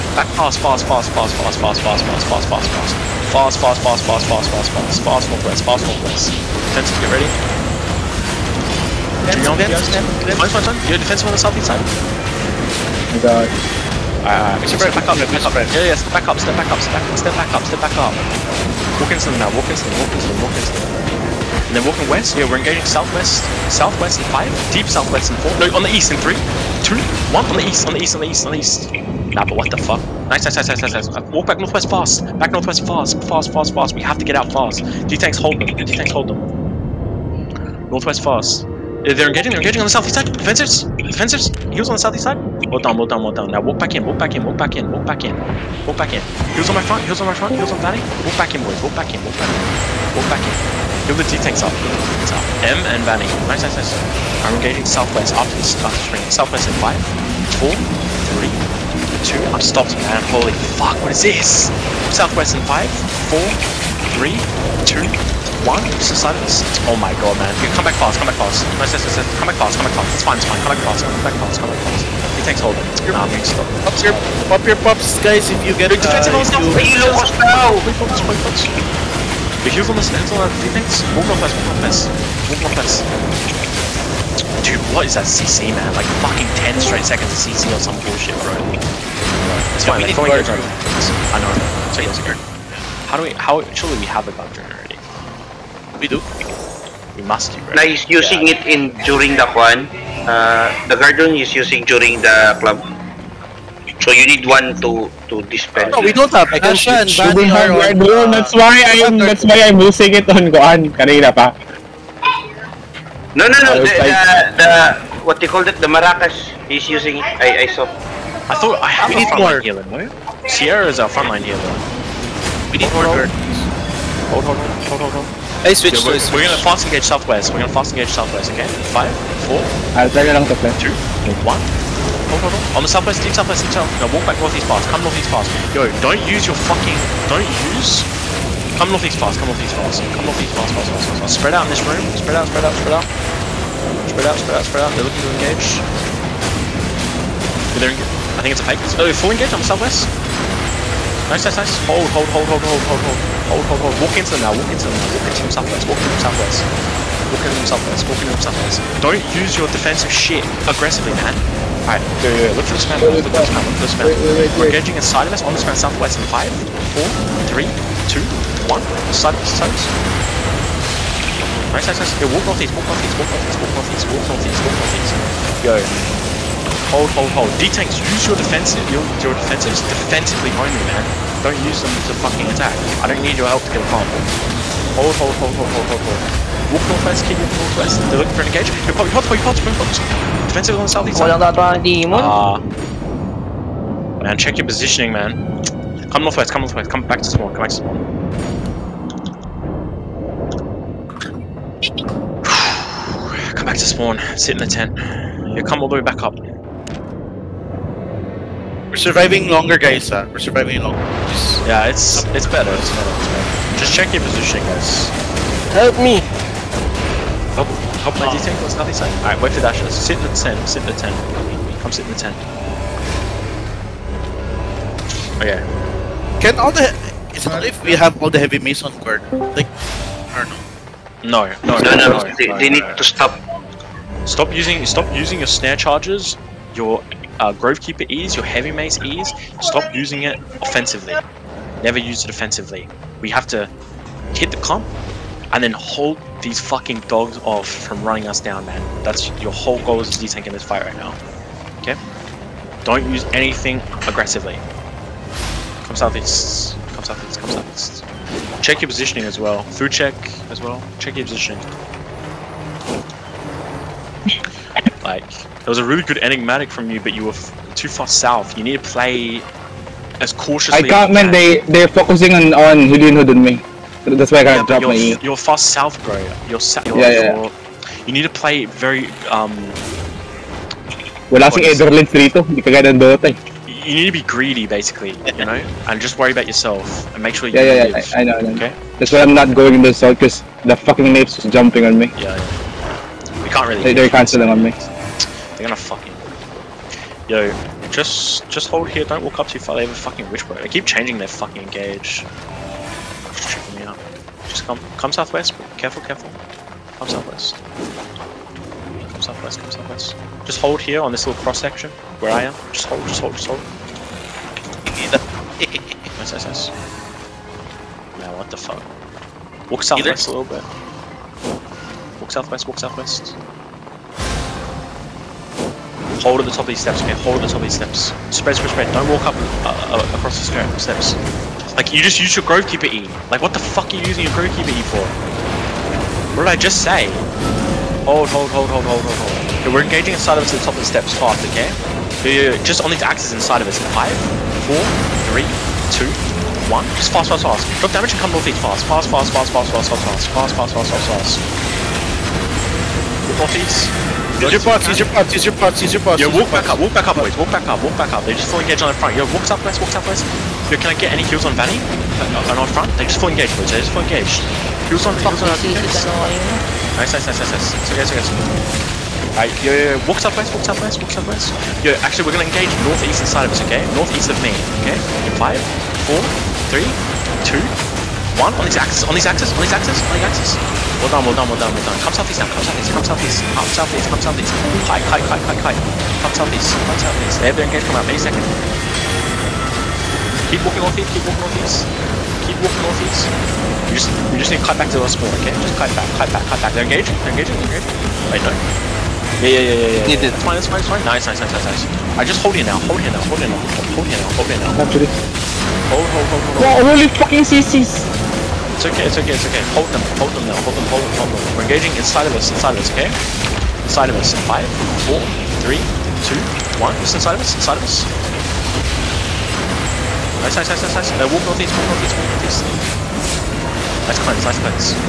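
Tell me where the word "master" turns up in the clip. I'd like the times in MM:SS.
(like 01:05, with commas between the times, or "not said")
not said.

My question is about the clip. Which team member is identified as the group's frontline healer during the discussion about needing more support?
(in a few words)
Sierra.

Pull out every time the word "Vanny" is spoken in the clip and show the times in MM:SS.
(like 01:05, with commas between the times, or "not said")
00:53, 06:01.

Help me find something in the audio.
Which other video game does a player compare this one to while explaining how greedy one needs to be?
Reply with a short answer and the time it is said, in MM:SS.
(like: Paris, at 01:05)
Dota, at 04:42.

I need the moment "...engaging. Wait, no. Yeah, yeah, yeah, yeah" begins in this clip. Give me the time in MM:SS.
06:37.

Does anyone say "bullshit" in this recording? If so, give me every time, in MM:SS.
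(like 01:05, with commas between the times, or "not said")
01:28.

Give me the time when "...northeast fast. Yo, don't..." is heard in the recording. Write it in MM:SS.
02:15.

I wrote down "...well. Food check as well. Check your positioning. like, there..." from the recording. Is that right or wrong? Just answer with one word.
right.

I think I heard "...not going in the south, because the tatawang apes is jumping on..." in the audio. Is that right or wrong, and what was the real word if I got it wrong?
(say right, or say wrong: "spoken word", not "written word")
wrong: "fucking", not "tatawang".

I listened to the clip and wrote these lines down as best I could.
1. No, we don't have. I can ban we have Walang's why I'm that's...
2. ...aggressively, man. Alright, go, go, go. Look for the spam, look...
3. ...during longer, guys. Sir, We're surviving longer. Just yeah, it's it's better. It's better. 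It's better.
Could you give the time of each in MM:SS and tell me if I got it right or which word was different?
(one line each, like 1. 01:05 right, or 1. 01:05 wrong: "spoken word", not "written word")
1. 01:45 wrong: "That", not "Walang"
2. 02:40 right
3. 03:29 wrong: "surviving", not "during".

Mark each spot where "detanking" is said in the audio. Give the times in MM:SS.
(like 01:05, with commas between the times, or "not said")
04:10.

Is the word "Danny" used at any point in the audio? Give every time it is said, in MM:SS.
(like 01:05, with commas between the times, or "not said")
00:47.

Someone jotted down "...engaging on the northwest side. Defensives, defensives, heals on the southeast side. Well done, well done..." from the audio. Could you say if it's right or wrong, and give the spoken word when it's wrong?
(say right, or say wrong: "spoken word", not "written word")
wrong: "southeast", not "northwest".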